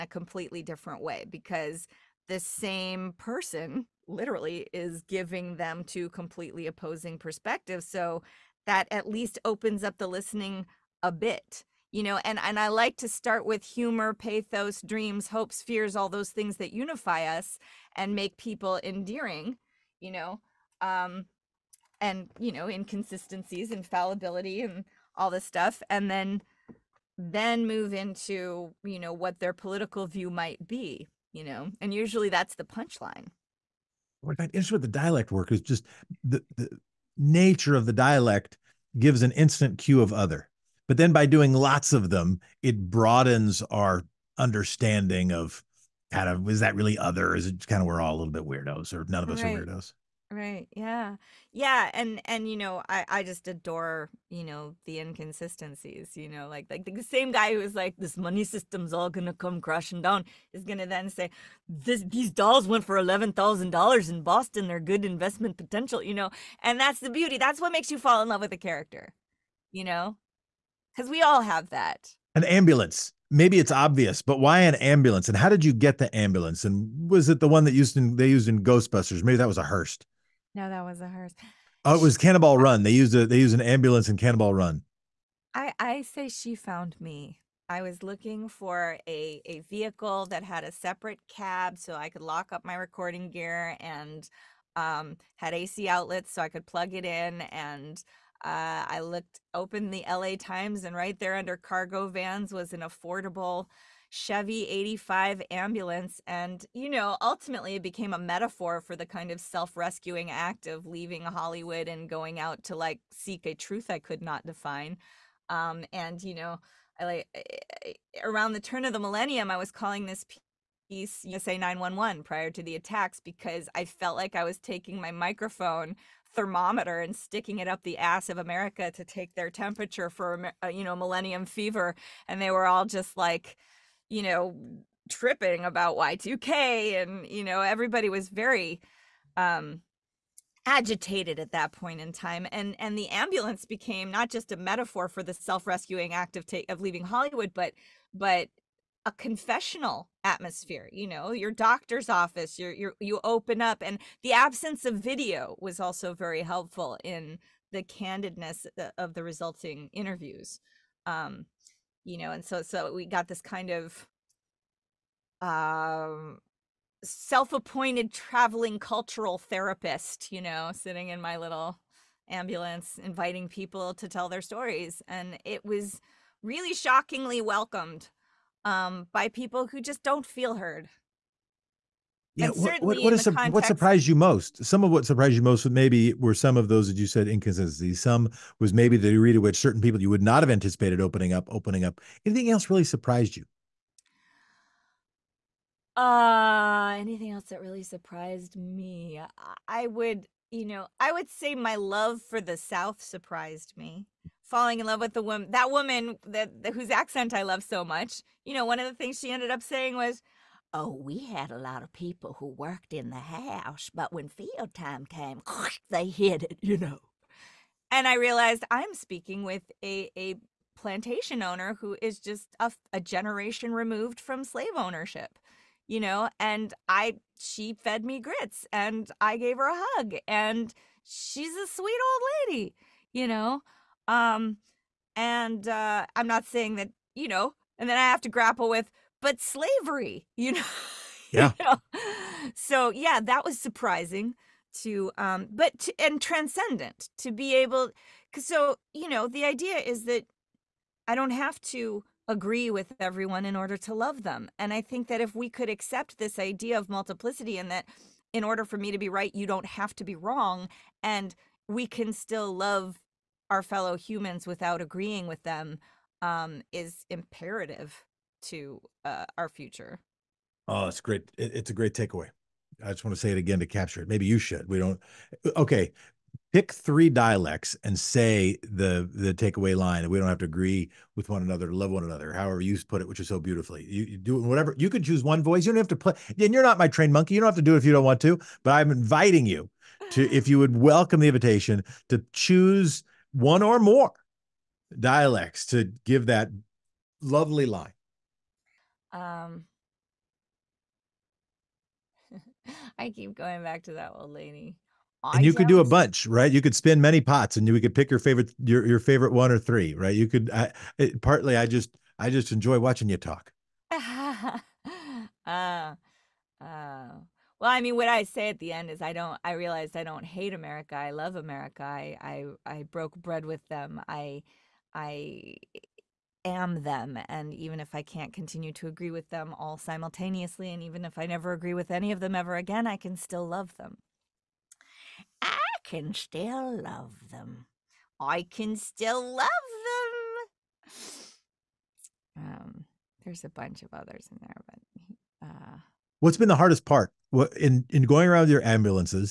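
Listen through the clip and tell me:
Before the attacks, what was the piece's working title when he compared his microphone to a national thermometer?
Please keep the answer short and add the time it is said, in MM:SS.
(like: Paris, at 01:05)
USA 911, at 02:01.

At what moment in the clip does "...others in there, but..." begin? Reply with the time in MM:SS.
05:43.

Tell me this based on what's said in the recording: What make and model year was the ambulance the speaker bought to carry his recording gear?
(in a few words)
Chevy 85.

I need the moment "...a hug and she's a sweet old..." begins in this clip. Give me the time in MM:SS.
03:49.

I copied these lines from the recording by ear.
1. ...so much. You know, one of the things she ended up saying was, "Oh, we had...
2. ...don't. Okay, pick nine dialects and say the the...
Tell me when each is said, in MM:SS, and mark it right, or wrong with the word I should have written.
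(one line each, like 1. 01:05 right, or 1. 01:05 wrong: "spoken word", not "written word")
1. 03:27 right
2. 04:34 wrong: "three", not "nine".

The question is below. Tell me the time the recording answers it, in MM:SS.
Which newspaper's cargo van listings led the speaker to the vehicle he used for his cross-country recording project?
01:40.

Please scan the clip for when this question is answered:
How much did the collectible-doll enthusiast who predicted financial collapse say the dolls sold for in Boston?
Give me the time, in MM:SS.
01:02.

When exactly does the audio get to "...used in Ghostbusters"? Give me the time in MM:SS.
01:18.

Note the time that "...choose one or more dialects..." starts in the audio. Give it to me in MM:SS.
04:52.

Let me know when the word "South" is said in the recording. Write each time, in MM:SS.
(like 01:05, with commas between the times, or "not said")
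03:22.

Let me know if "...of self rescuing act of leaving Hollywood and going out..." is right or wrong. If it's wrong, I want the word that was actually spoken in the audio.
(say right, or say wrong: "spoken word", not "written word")
right.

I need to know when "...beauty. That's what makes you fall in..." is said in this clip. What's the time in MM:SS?
01:07.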